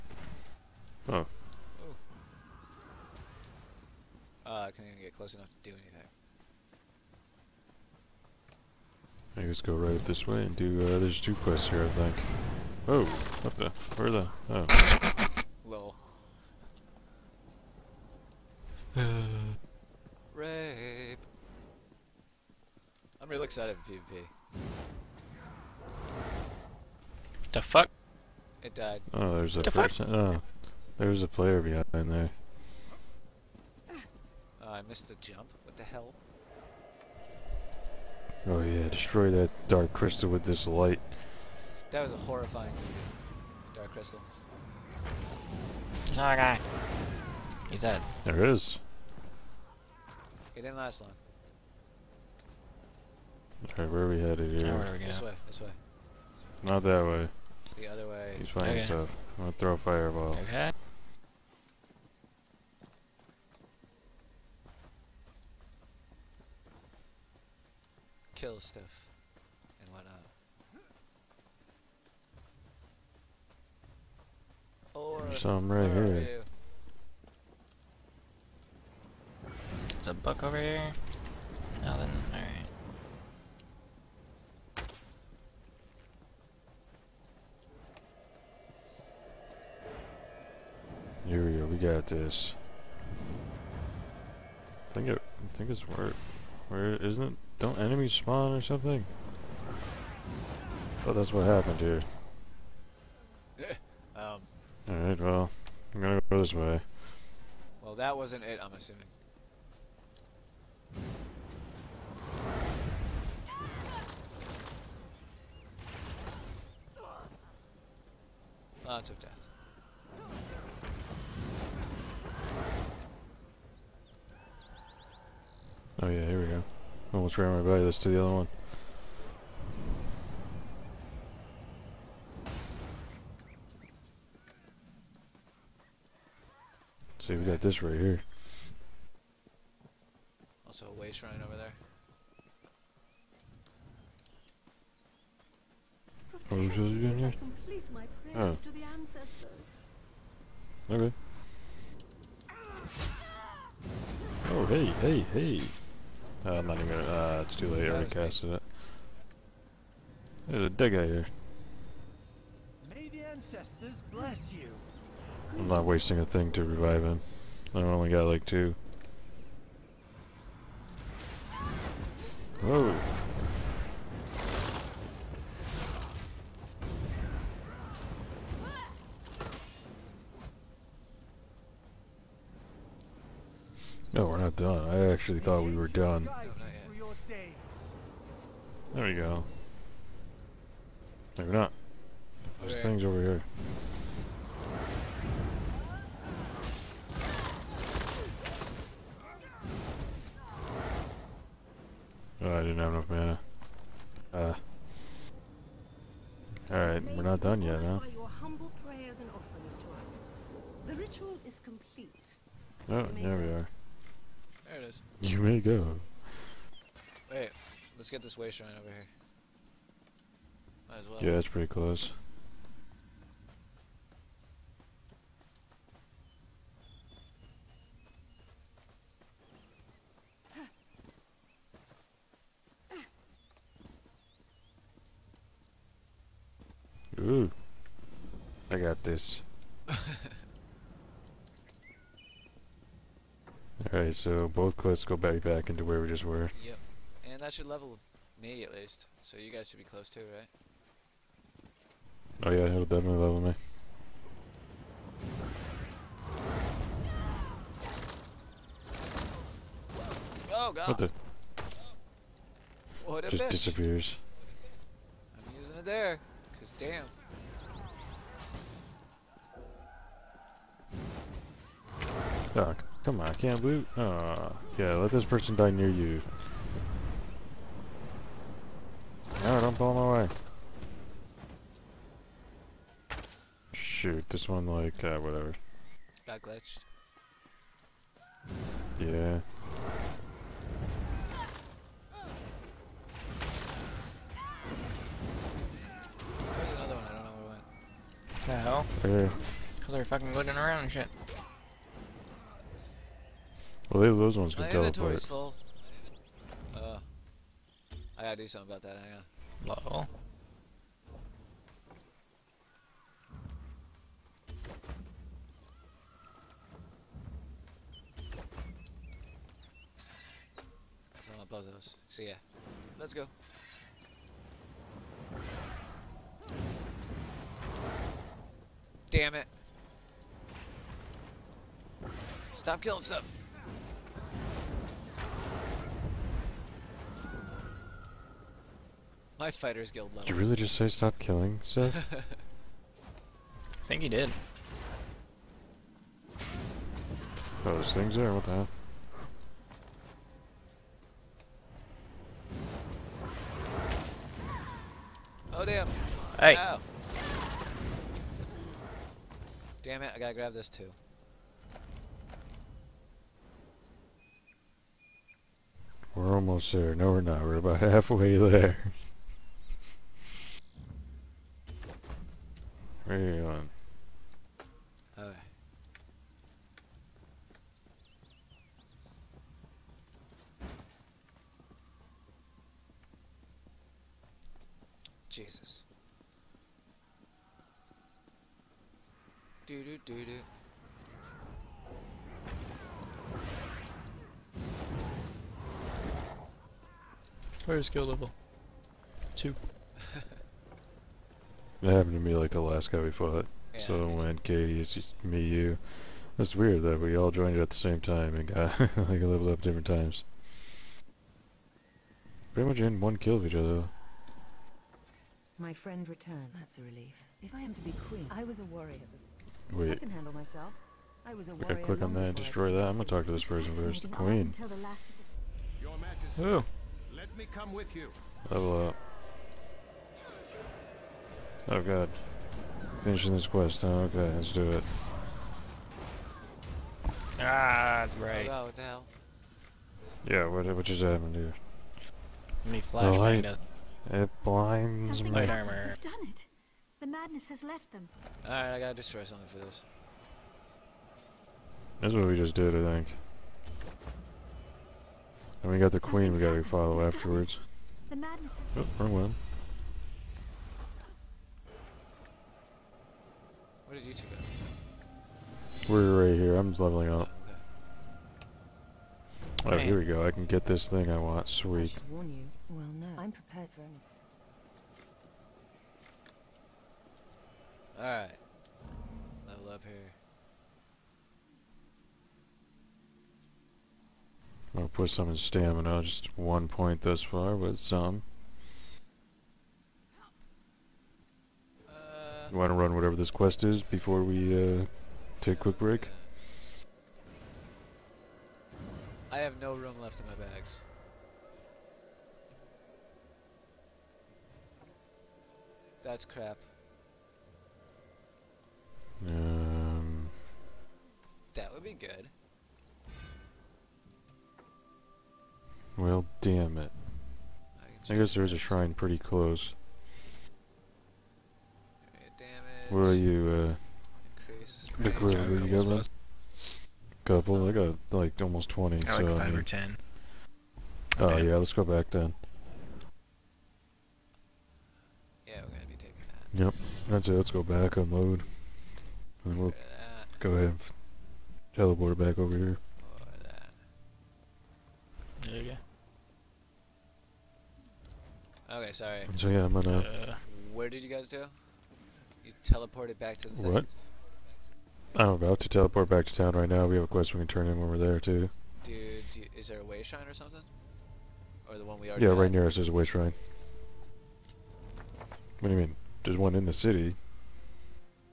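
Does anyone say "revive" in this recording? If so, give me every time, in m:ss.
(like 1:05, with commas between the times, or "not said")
2:46.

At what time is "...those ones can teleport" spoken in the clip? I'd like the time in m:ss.
5:04.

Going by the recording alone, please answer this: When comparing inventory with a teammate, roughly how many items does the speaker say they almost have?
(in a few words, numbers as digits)
20.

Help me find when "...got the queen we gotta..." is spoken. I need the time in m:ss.
7:35.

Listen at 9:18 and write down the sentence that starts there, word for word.
Dude, is there a way shrine or something?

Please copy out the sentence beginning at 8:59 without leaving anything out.
And we'll go ahead Teleport back over here.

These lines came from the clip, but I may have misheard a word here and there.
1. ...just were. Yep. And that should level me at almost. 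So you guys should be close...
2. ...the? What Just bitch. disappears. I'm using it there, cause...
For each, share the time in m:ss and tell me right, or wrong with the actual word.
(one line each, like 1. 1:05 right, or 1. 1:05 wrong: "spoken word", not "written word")
1. 4:06 wrong: "least", not "almost"
2. 4:20 right.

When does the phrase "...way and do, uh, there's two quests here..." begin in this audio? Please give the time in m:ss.
0:10.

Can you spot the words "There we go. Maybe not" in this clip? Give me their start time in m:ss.
3:08.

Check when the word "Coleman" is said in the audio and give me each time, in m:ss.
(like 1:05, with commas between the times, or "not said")
not said.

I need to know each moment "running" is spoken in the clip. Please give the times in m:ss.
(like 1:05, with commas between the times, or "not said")
0:58, 2:21.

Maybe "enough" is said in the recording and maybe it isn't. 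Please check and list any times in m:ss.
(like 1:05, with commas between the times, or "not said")
0:05, 3:22.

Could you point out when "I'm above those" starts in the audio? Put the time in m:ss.
5:21.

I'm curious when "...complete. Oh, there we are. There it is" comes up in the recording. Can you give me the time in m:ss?
3:31.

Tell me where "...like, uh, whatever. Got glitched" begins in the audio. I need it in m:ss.
4:44.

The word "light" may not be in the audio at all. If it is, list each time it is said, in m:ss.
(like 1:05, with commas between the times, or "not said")
0:40, 7:23.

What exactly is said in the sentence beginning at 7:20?
Yeah, what, what just happened here?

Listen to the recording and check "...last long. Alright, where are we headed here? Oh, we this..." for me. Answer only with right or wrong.
right.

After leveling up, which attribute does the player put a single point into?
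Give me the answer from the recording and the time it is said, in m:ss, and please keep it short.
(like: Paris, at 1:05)
Stamina, at 8:05.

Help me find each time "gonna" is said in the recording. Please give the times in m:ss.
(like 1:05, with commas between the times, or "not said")
0:59, 1:46, 2:36, 7:02, 8:55, 9:09.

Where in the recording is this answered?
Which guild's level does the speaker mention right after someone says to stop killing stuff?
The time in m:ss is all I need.
5:39.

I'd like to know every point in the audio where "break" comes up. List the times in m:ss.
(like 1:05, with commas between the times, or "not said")
8:15.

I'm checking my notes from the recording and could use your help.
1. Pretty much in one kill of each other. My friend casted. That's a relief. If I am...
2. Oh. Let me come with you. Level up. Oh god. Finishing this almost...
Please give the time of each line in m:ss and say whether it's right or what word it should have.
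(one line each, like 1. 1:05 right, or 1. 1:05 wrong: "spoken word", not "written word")
1. 6:52 wrong: "returned", not "casted"
2. 7:06 wrong: "quest", not "almost".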